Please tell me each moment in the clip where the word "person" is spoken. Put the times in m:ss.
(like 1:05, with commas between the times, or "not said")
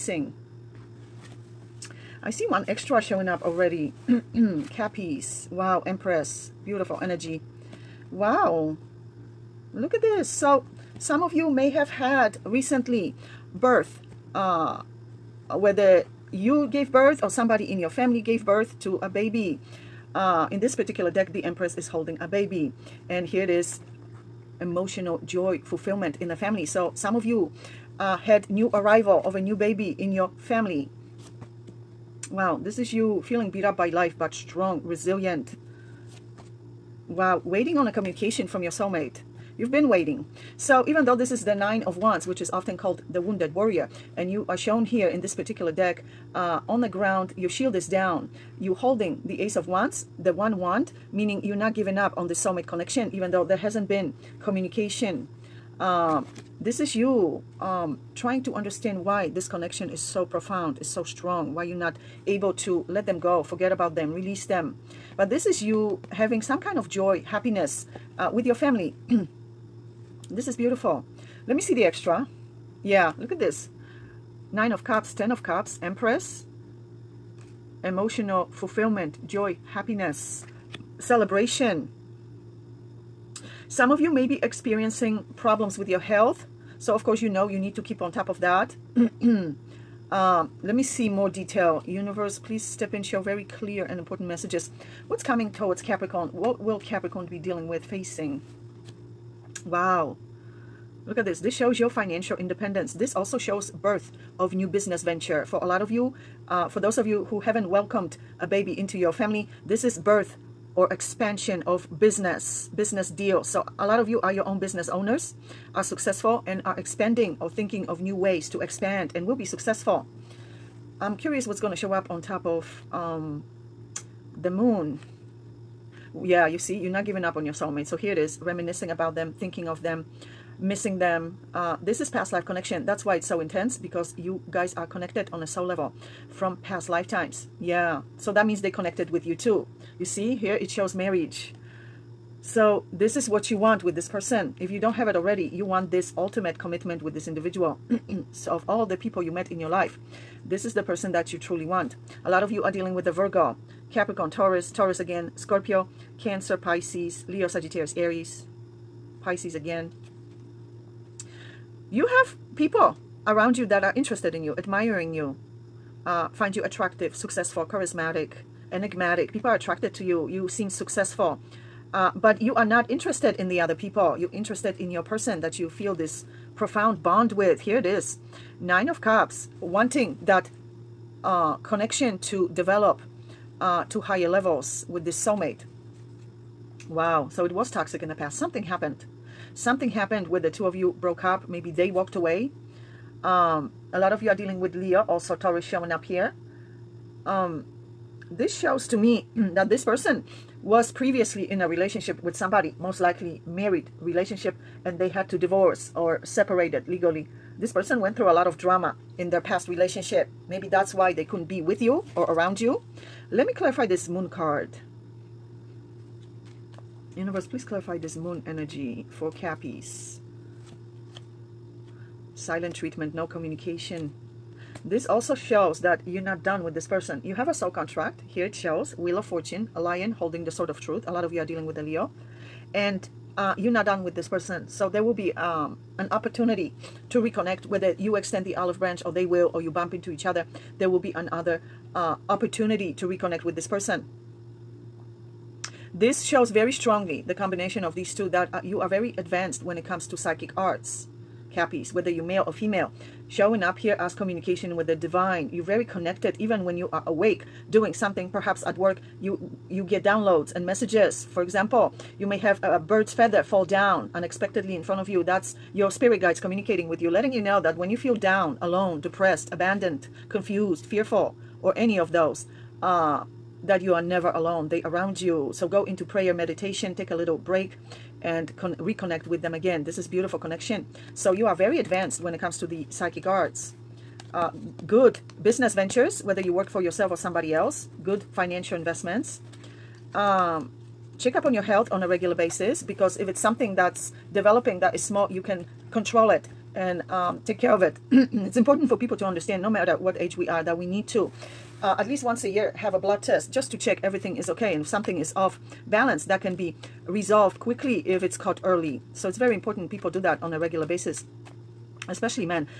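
2:24, 2:30, 2:55, 3:19, 3:27, 3:46, 3:54, 4:03.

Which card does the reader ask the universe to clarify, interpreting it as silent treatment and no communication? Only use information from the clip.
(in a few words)
The Moon.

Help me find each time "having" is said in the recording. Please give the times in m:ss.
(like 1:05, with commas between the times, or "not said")
1:06.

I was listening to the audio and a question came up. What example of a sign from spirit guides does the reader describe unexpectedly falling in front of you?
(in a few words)
A bird's feather.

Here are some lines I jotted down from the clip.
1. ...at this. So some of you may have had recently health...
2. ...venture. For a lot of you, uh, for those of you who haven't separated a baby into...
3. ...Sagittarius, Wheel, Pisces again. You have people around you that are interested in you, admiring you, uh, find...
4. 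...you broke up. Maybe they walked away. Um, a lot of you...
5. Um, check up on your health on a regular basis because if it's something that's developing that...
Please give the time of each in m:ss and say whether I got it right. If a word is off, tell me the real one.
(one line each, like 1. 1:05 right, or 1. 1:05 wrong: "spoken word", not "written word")
1. 0:09 wrong: "birth", not "health"
2. 1:45 wrong: "welcomed", not "separated"
3. 2:37 wrong: "Aries", not "Wheel"
4. 3:10 right
5. 4:50 right.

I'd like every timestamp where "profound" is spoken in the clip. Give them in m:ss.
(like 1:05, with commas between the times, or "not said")
1:00, 2:56.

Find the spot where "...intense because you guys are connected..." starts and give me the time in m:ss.
2:13.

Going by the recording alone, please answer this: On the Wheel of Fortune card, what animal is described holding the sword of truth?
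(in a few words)
A lion.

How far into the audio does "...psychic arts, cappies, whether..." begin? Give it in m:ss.
4:10.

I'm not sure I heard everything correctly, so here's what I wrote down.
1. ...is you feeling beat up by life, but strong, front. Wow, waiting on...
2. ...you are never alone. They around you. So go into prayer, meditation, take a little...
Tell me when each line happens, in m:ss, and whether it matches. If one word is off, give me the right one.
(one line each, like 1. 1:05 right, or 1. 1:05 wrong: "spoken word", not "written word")
1. 0:32 wrong: "resilient", not "front"
2. 4:33 right.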